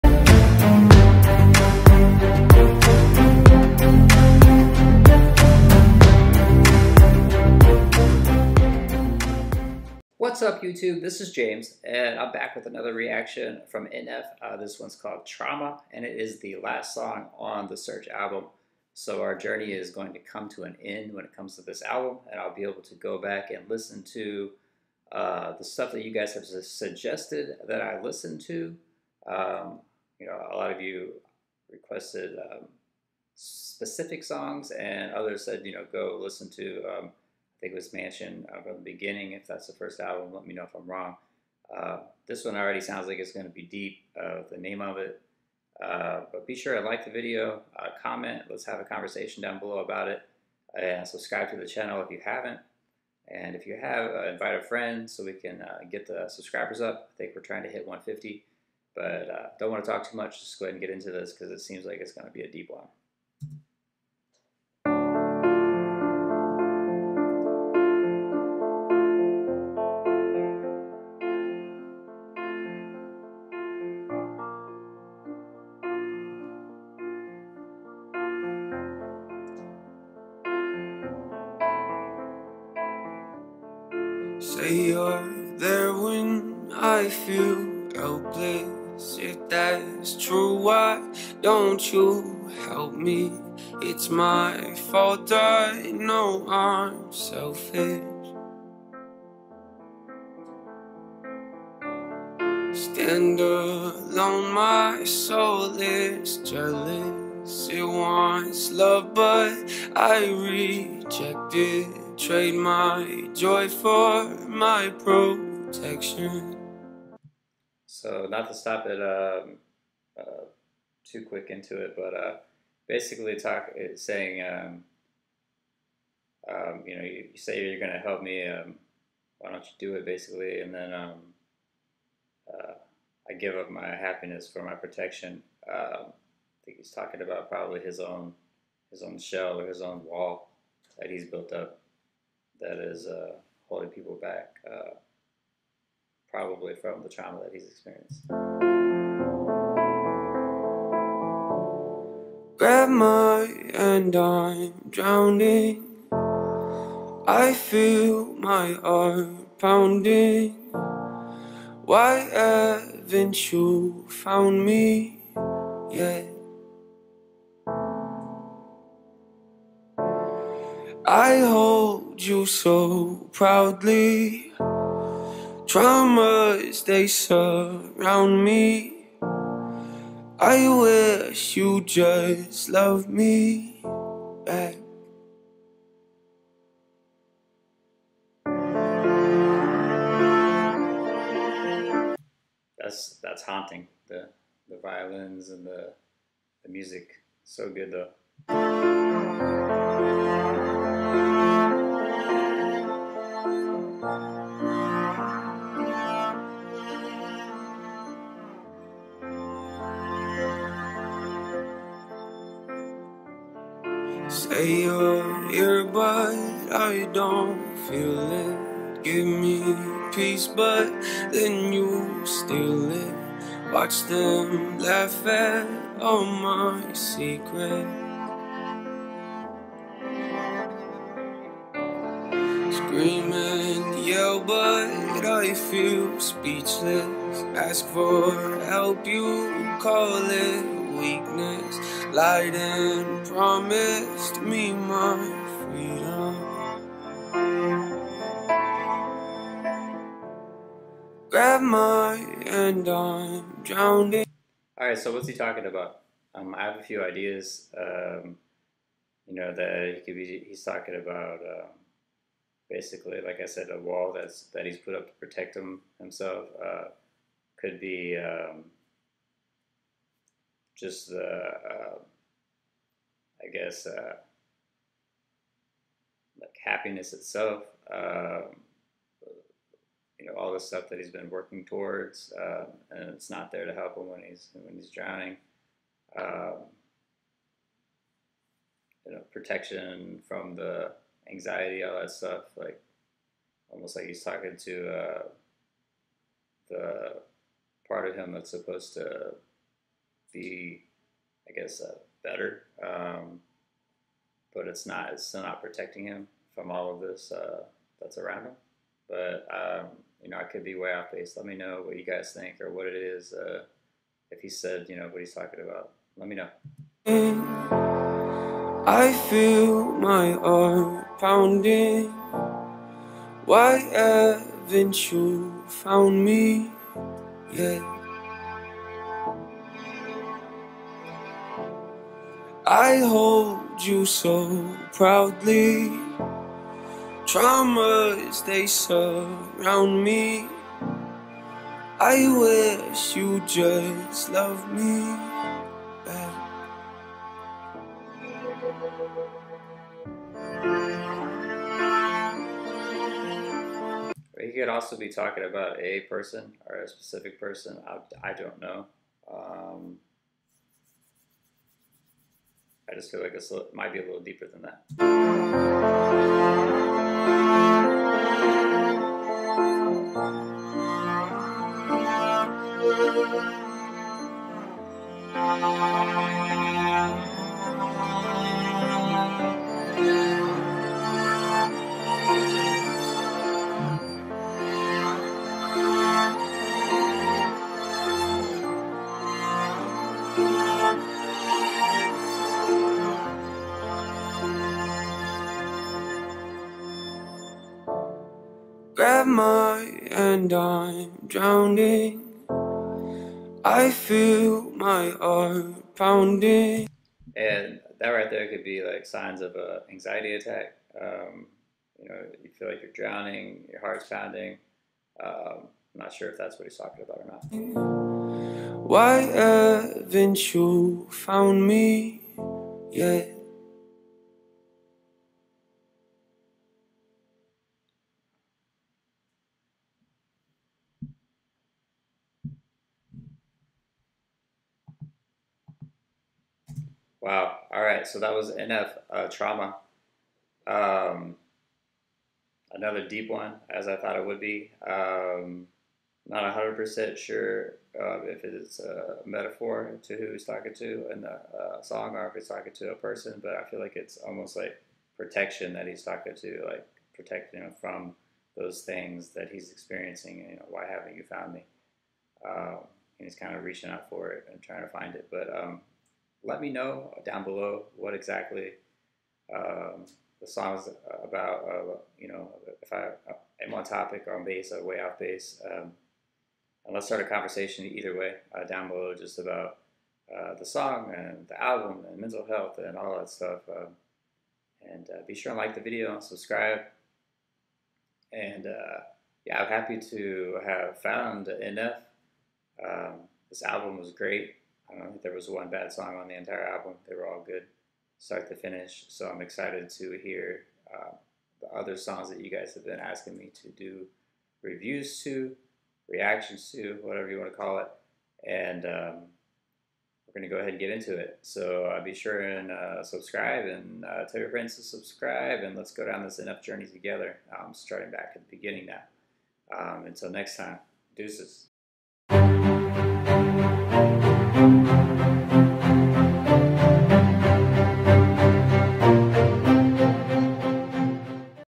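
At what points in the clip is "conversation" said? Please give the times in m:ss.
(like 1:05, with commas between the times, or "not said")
0:48, 7:57.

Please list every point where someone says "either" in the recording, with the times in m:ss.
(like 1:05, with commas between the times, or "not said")
7:57.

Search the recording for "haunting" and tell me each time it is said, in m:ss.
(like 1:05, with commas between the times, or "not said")
3:13.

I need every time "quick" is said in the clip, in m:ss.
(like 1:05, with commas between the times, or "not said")
2:01.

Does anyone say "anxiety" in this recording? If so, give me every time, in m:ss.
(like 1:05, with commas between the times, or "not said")
4:51, 6:49.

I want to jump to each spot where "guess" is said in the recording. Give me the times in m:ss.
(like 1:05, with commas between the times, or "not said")
4:33, 5:01.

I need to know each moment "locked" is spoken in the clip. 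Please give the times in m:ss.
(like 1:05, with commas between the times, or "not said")
not said.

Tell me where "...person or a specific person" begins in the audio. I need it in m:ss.
5:56.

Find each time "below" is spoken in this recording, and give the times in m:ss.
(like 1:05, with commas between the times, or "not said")
0:49, 7:47, 7:58.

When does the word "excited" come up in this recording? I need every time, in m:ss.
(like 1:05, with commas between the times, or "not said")
8:19.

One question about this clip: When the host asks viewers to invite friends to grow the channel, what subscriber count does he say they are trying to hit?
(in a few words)
150.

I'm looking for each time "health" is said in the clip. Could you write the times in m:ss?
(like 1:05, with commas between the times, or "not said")
8:02.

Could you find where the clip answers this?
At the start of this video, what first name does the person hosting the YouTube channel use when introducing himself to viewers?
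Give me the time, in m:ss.
0:11.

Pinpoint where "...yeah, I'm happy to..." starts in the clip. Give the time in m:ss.
8:09.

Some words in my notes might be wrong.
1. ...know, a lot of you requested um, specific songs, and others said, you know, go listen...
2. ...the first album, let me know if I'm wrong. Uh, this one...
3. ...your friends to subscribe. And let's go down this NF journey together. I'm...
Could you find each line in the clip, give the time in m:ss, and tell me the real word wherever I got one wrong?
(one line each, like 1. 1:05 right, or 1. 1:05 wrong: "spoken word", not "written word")
1. 0:30 right
2. 0:39 right
3. 8:34 right.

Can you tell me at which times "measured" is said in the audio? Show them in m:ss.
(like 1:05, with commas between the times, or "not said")
not said.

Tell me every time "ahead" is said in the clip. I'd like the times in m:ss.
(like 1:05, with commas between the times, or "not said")
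1:00, 8:30.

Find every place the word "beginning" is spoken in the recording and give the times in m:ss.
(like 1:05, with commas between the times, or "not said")
0:38, 8:38.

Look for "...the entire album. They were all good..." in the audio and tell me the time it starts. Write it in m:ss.
8:16.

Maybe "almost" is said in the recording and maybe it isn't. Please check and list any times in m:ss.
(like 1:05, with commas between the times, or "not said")
4:53, 7:34.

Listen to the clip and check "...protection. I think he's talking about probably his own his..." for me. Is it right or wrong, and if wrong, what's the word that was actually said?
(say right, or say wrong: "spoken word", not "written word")
right.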